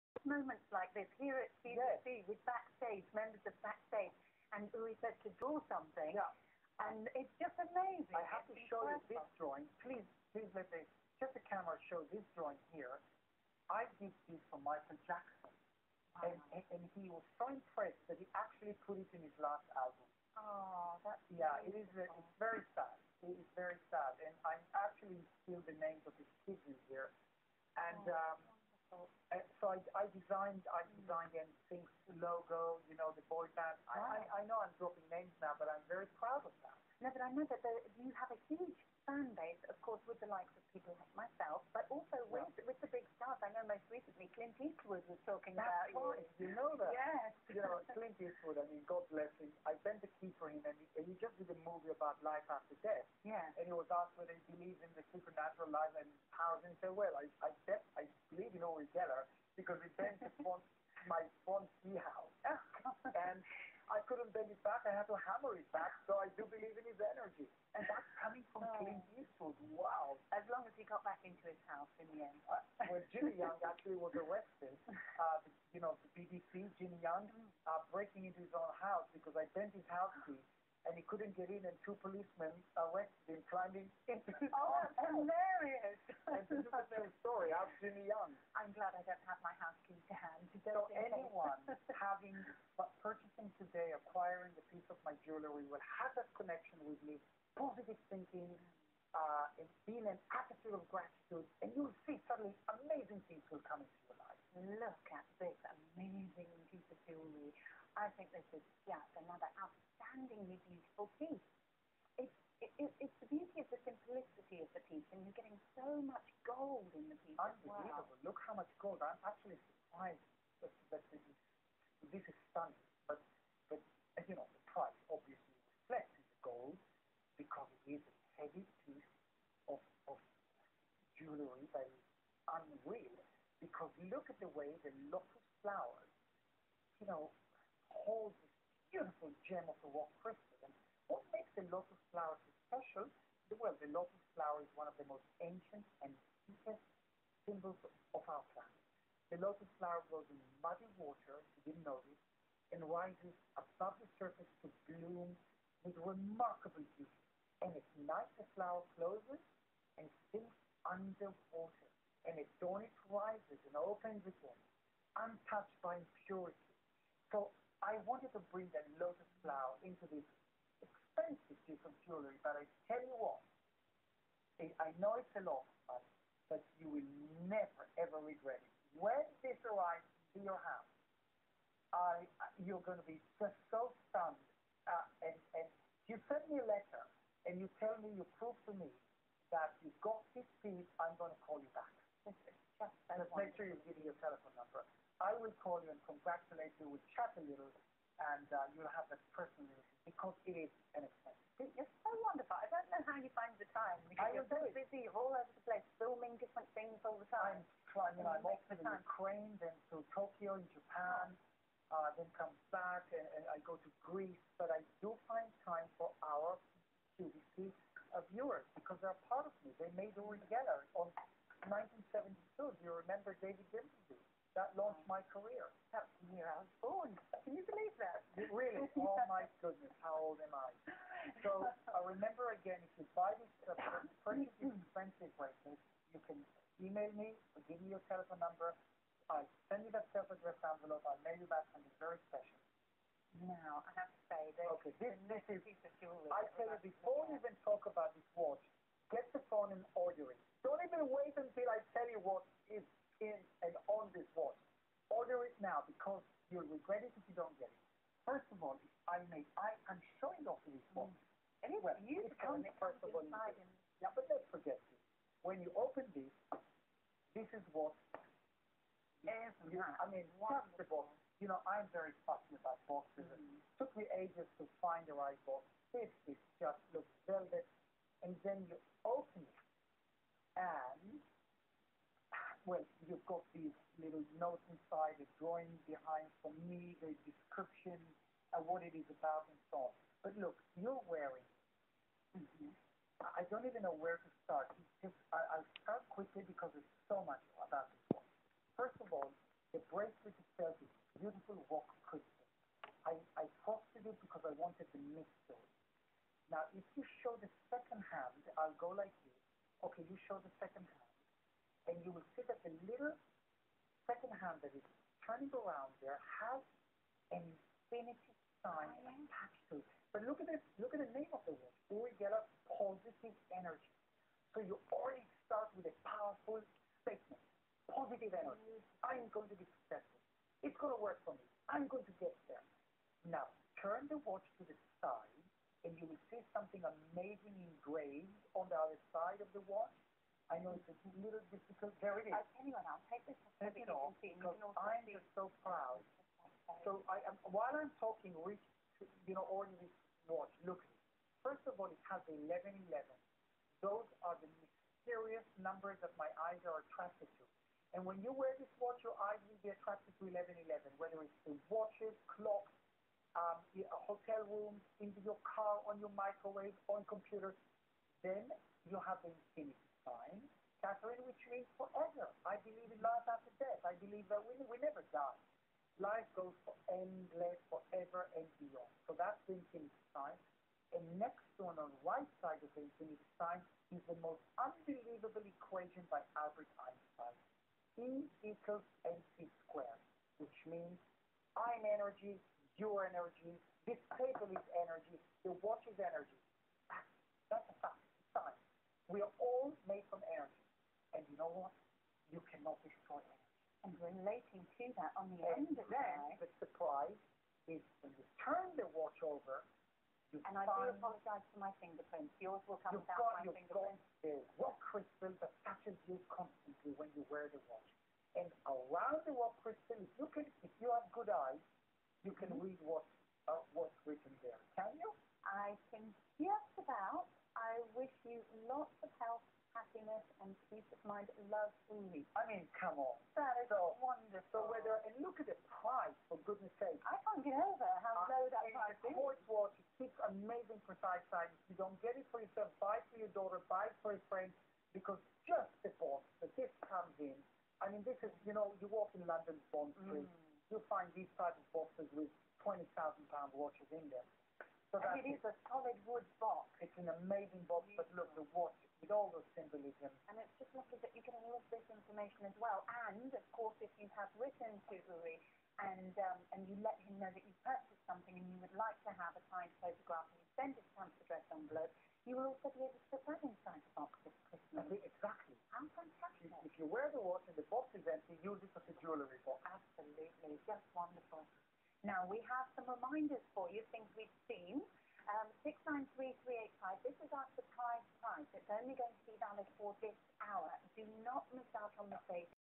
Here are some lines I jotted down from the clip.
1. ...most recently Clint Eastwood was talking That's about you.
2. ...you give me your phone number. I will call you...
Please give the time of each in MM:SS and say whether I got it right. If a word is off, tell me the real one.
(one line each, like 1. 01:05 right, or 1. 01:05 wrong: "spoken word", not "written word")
1. 00:43 right
2. 03:13 wrong: "telephone", not "phone".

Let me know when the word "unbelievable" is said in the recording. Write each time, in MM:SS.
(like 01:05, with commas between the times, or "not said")
01:57, 06:24.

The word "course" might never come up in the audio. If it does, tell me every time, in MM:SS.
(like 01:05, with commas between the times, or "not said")
00:39, 07:43.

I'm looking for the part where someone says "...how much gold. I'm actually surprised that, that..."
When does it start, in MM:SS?
01:58.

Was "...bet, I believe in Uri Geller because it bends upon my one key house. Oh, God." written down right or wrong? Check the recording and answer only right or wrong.
right.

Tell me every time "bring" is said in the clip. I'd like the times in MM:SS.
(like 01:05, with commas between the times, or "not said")
02:48.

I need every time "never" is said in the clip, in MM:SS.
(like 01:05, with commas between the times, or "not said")
02:57, 06:14.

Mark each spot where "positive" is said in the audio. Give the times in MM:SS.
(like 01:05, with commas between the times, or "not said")
01:37, 05:22, 05:27.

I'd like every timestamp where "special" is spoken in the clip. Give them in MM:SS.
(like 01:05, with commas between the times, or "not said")
02:22, 04:02.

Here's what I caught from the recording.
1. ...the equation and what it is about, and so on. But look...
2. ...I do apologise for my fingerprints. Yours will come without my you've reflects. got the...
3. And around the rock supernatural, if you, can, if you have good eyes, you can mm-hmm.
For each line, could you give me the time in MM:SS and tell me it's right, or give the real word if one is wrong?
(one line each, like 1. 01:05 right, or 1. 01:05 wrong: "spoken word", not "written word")
1. 04:47 wrong: "description", not "equation"
2. 06:50 wrong: "fingerprints", not "reflects"
3. 06:58 wrong: "crystal", not "supernatural".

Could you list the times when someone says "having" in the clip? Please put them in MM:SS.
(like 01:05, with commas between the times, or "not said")
01:31.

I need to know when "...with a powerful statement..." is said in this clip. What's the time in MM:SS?
05:25.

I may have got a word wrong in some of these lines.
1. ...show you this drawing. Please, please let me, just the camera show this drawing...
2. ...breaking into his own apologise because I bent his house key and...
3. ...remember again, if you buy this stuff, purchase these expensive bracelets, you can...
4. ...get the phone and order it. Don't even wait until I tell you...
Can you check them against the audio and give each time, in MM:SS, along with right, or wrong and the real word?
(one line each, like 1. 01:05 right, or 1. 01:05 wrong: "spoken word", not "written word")
1. 00:08 right
2. 01:17 wrong: "house", not "apologise"
3. 03:52 right
4. 04:09 right.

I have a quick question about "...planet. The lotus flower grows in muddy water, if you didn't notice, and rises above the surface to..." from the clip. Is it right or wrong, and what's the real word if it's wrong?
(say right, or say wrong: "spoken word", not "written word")
right.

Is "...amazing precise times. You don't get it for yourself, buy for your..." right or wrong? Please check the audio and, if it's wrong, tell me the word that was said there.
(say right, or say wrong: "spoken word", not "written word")
right.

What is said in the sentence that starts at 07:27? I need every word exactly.
I mean, this is, you know, you walk in London's Bond Street, mm.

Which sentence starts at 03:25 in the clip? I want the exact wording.
all over the place filming different things all the time.